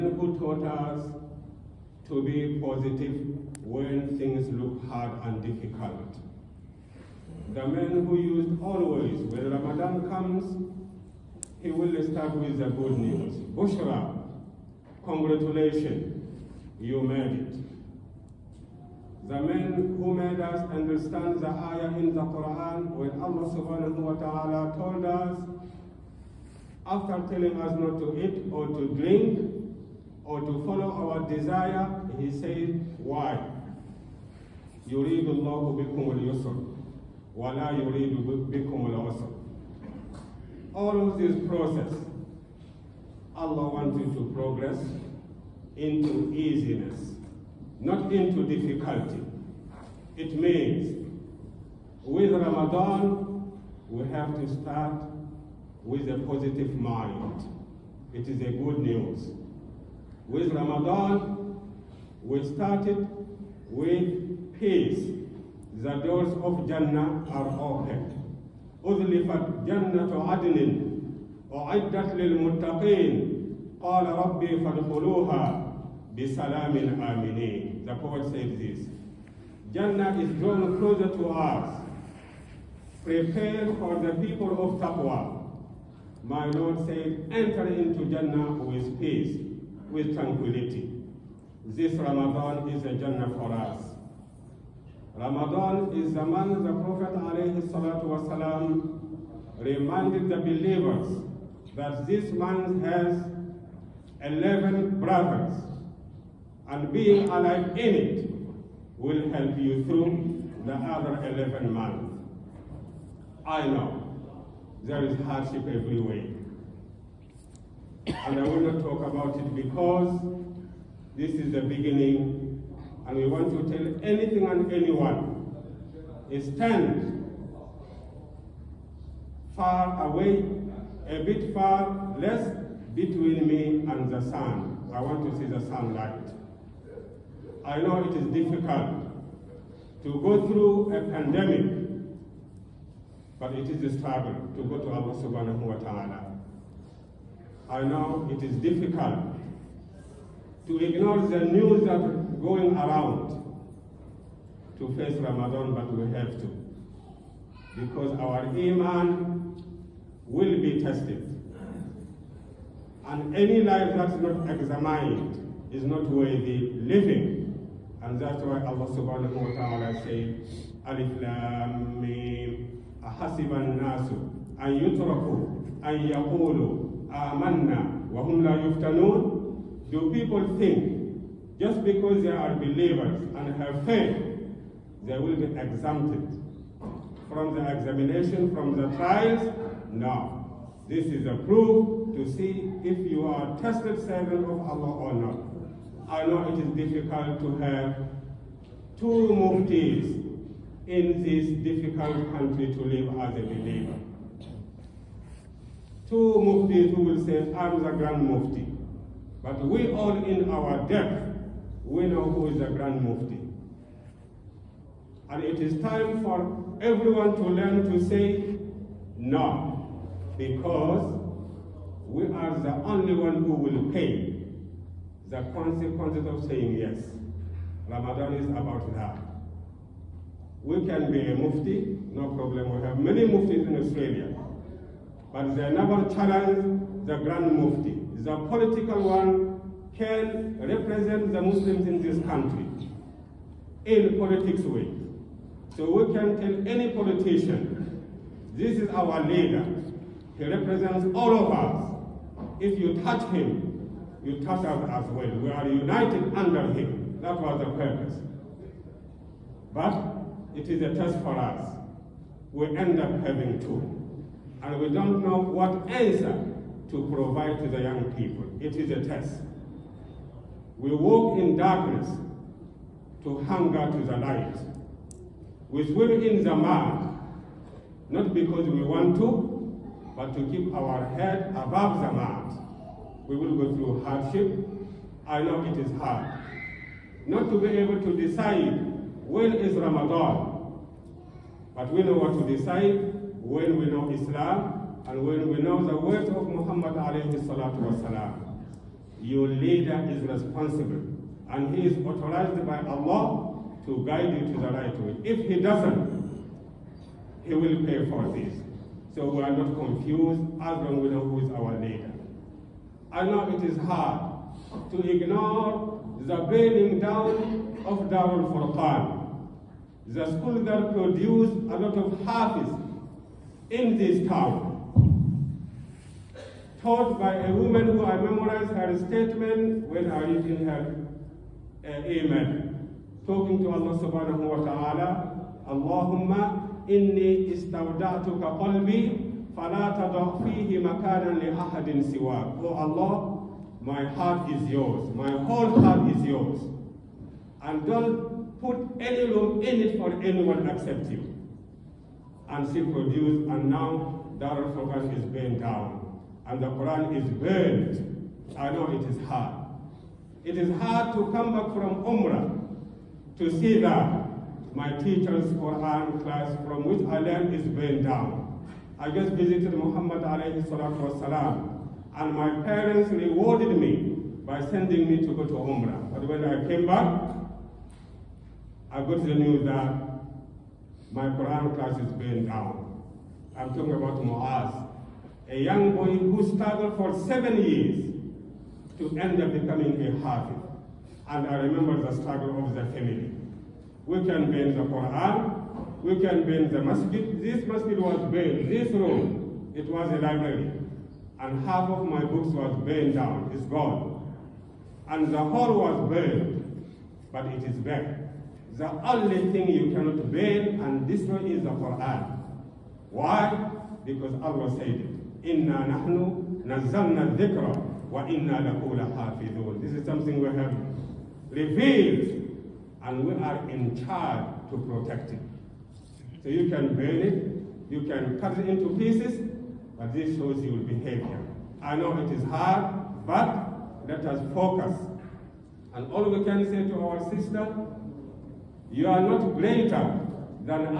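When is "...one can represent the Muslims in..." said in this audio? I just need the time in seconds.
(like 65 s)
239 s.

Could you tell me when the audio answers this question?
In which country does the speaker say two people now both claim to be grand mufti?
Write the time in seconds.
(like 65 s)
233 s.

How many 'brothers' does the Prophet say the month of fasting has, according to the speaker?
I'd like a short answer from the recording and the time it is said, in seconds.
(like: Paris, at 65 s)
11, at 104 s.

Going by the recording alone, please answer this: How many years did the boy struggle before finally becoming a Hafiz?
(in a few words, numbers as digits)
7.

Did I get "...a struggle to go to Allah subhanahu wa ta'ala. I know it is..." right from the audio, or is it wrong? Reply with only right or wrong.
right.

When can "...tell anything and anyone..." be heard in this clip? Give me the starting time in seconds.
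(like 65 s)
123 s.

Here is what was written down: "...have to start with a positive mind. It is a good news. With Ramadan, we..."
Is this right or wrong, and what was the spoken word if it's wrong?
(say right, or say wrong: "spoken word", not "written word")
right.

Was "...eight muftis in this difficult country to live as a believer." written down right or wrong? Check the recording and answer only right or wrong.
wrong.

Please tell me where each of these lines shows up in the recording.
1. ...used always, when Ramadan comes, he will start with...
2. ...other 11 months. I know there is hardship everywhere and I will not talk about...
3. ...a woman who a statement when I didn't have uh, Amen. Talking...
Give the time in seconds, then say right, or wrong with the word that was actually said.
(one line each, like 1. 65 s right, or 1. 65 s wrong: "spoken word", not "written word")
1. 8 s right
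2. 110 s right
3. 327 s right.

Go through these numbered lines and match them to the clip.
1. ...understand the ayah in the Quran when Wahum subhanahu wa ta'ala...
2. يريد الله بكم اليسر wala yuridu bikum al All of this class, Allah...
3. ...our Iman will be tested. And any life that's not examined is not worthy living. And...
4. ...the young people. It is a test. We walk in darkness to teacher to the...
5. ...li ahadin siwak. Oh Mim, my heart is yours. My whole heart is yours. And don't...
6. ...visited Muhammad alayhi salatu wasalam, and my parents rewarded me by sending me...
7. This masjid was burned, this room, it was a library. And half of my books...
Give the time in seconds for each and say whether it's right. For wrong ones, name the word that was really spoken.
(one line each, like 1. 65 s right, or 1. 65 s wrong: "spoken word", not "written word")
1. 20 s wrong: "Allah", not "Wahum"
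2. 34 s wrong: "process", not "class"
3. 158 s right
4. 267 s wrong: "hunger", not "teacher"
5. 341 s wrong: "Allah", not "Mim"
6. 369 s right
7. 397 s right.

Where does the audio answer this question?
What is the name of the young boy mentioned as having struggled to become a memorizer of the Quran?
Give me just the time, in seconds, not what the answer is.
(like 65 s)
384 s.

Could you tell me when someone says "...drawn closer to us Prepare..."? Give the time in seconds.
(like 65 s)
80 s.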